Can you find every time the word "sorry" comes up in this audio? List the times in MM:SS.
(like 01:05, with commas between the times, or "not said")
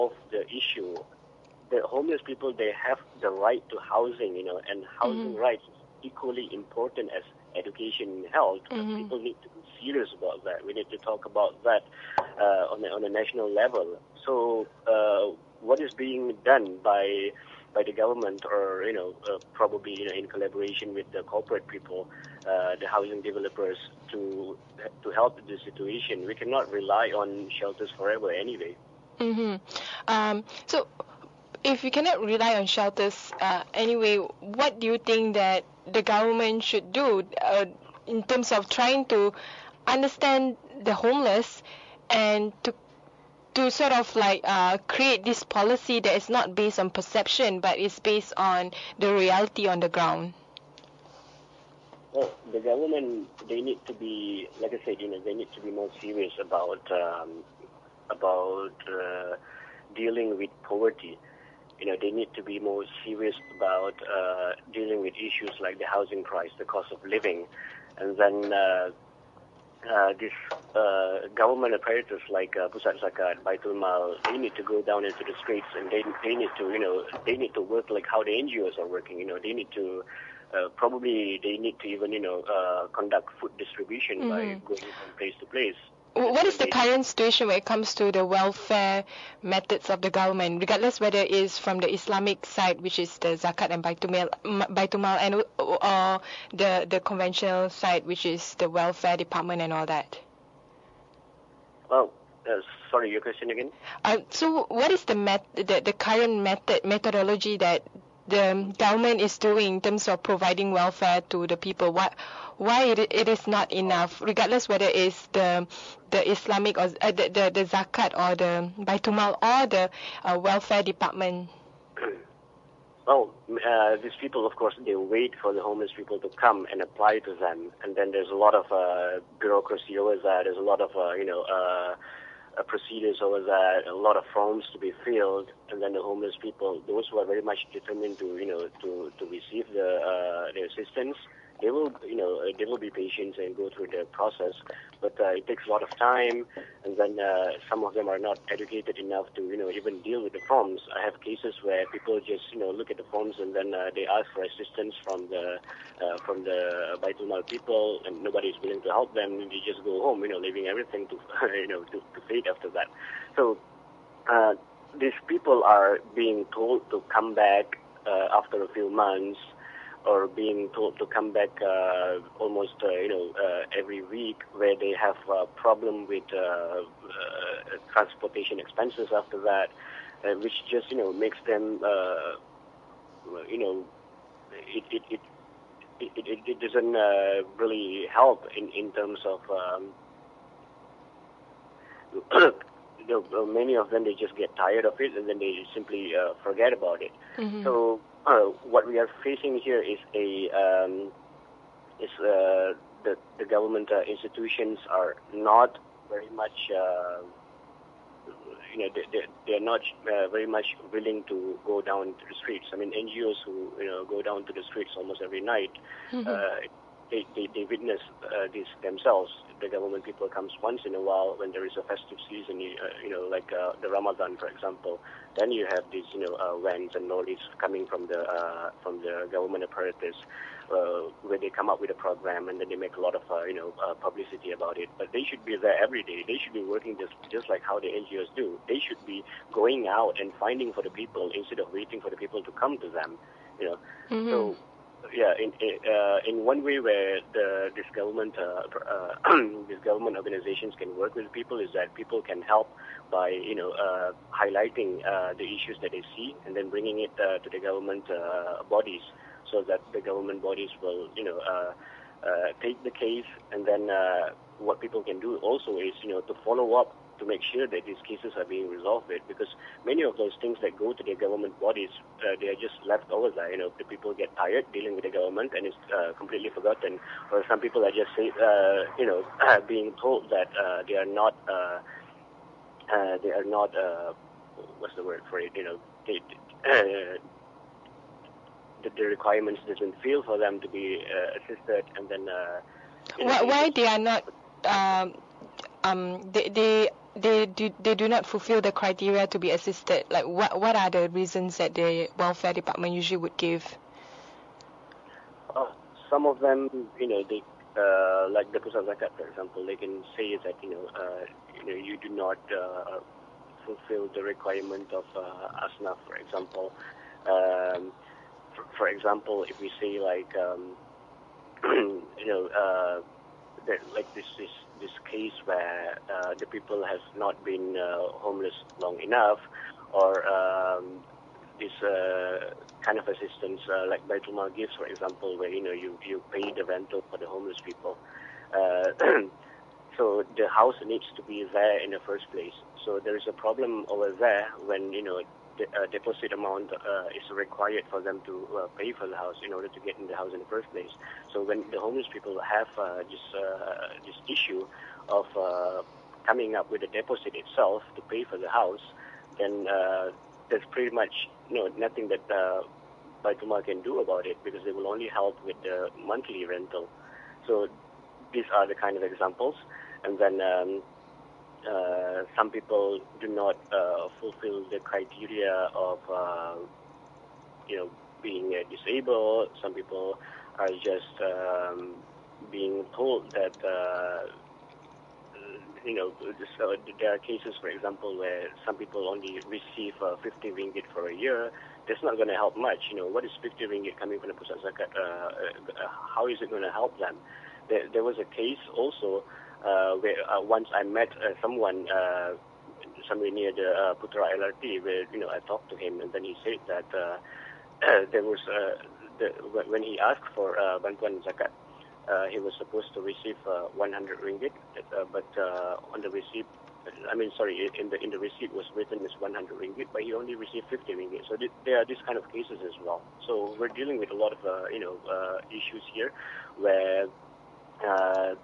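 01:42, 06:57.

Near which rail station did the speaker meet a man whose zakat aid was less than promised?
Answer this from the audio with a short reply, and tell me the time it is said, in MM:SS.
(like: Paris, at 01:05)
Putra LRT, at 06:43.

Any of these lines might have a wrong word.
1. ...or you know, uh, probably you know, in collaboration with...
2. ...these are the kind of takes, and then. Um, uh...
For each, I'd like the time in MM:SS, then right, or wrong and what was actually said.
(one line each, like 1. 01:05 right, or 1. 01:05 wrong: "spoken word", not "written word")
1. 00:18 right
2. 06:08 wrong: "examples", not "takes".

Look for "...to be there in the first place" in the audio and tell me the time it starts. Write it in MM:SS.
05:41.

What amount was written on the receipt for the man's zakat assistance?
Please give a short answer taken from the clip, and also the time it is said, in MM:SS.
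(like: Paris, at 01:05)
100 ringgit, at 06:58.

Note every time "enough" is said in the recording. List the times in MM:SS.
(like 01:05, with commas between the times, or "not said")
01:53, 02:28, 05:28.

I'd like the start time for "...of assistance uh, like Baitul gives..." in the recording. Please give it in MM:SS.
05:32.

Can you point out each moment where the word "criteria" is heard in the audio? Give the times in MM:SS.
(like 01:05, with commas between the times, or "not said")
04:58, 06:14.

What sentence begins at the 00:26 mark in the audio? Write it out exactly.
We cannot rely on shelters forever, anyway.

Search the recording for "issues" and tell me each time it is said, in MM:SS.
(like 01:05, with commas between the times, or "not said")
00:00, 01:05, 04:15, 05:54, 07:05.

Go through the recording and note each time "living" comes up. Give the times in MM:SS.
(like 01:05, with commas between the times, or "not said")
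01:07.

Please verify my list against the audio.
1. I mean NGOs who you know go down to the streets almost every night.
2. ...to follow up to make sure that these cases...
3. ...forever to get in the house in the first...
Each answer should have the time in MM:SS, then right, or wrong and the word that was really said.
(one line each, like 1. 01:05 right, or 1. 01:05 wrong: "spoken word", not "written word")
1. 03:32 right
2. 04:26 right
3. 05:49 wrong: "order", not "forever".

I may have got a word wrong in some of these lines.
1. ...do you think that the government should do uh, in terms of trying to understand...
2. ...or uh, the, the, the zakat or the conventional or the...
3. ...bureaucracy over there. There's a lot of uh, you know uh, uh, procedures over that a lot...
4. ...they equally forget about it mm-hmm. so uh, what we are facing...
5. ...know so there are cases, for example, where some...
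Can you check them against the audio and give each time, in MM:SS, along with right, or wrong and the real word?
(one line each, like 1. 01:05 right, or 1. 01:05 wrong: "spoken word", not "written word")
1. 00:34 right
2. 01:56 wrong: "baitumal", not "conventional"
3. 02:09 right
4. 03:15 wrong: "simply", not "equally"
5. 06:25 right.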